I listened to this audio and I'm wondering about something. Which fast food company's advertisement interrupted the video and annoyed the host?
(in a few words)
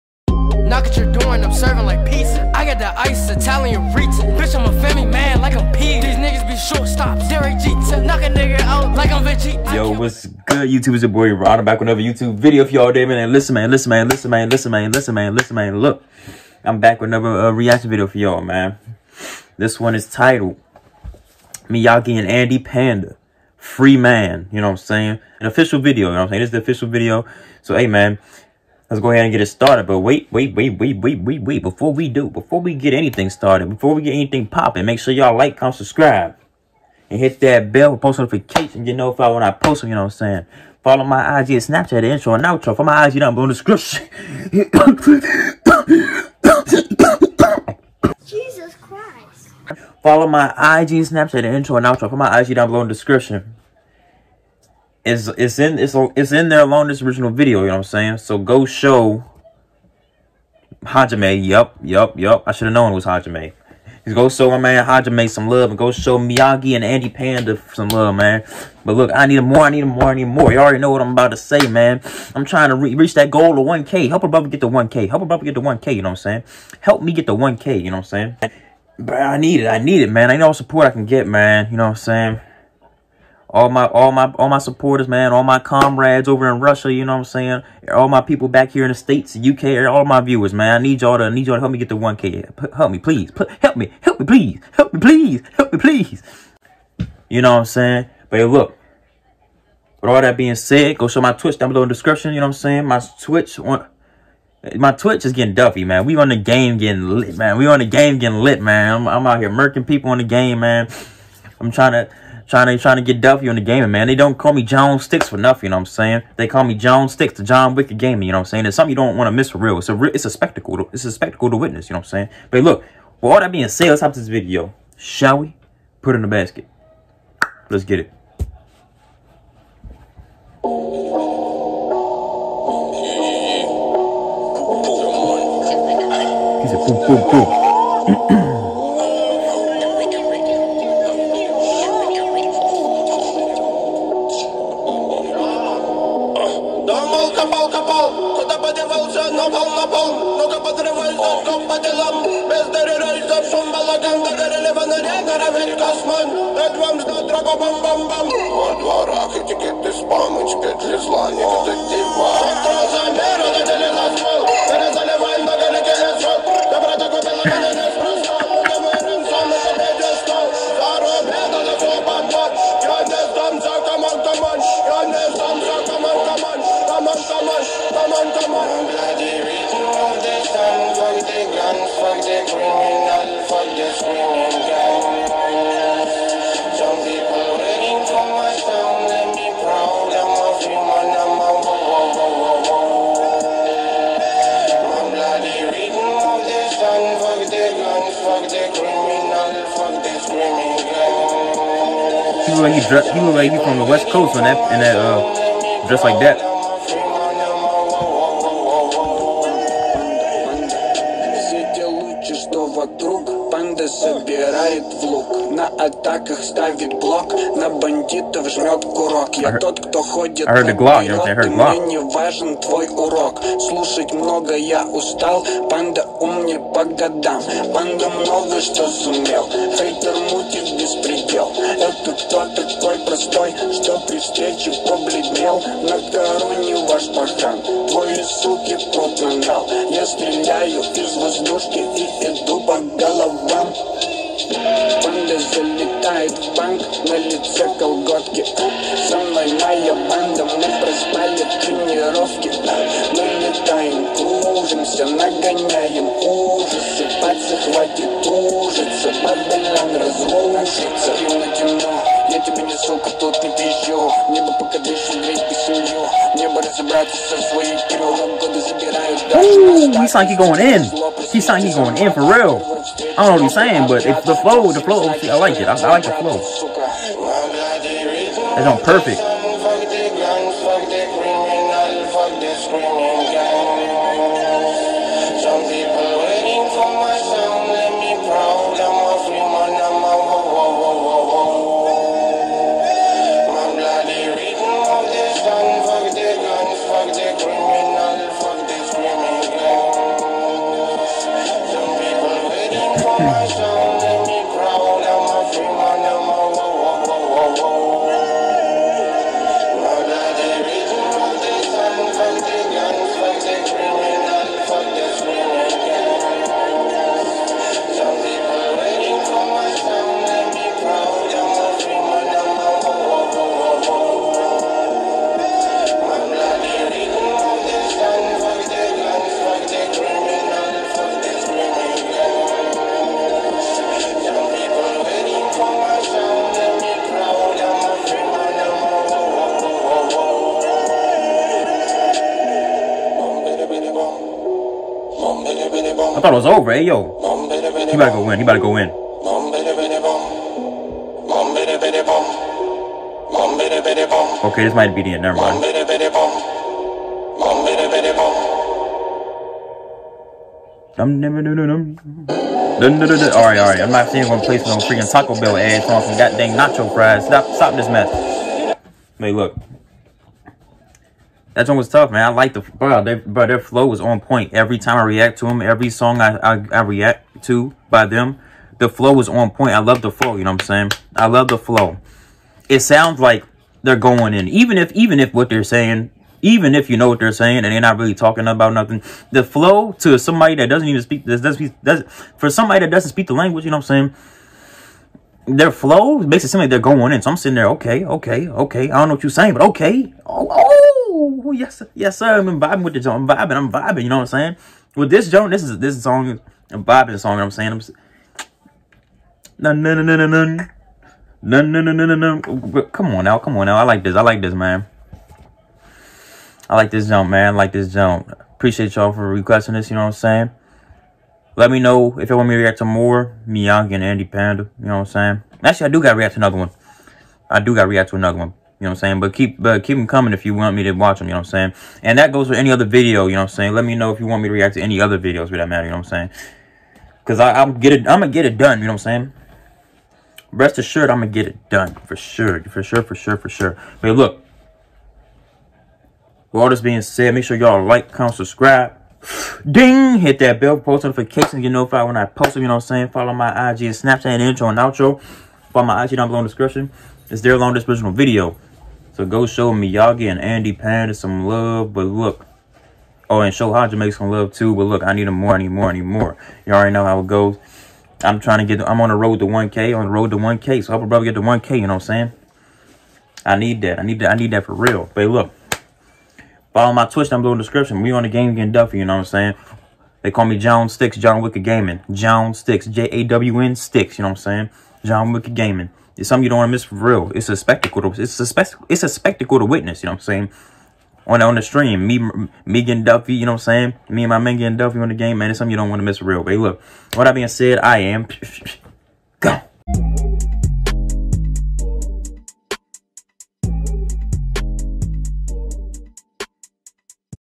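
Taco Bell.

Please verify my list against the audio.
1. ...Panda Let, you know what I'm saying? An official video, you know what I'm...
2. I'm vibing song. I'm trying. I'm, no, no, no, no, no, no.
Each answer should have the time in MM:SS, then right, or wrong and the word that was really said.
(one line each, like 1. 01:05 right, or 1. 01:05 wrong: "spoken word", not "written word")
1. 00:22 wrong: "Freeman", not "Let"
2. 06:46 wrong: "saying", not "trying".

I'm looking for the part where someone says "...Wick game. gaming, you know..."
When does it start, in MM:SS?
01:57.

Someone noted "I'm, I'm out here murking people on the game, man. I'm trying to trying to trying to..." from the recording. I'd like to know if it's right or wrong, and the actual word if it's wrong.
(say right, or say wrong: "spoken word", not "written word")
right.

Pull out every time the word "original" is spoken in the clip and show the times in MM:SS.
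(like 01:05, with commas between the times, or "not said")
00:57, 07:37.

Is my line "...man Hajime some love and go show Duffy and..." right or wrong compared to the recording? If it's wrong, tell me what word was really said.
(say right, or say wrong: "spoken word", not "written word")
wrong: "Miyagi", not "Duffy".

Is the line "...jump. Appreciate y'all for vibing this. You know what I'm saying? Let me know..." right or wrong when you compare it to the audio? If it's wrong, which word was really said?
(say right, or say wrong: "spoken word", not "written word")
wrong: "requesting", not "vibing".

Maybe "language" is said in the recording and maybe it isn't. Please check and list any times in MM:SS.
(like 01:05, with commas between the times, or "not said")
06:33.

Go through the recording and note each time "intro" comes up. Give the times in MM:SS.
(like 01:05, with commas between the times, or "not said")
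00:42, 00:51, 07:34.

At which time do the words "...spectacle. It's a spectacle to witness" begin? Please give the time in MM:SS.
08:08.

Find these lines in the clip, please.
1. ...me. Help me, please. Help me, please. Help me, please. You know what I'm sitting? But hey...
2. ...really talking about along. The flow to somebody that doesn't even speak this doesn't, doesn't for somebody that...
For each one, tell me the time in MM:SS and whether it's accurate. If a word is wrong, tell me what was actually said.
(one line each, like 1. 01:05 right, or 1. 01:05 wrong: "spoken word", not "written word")
1. 01:33 wrong: "saying", not "sitting"
2. 06:27 wrong: "nothing", not "along".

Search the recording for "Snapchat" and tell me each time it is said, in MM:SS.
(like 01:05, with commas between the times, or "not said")
00:41, 00:51, 07:33.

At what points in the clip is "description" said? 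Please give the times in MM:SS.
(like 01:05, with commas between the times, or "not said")
00:43, 00:52, 01:41, 07:36, 07:57.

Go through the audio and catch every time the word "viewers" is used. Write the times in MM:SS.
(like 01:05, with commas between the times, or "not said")
01:30.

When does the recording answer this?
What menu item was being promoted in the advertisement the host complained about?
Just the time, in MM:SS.
06:06.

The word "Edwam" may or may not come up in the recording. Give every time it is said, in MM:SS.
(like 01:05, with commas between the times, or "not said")
02:36.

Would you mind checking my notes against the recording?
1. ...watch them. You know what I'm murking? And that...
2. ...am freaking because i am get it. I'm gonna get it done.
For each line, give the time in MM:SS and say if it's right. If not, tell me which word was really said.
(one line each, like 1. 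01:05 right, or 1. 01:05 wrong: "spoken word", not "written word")
1. 07:10 wrong: "saying", not "murking"
2. 07:17 wrong: "saying", not "freaking".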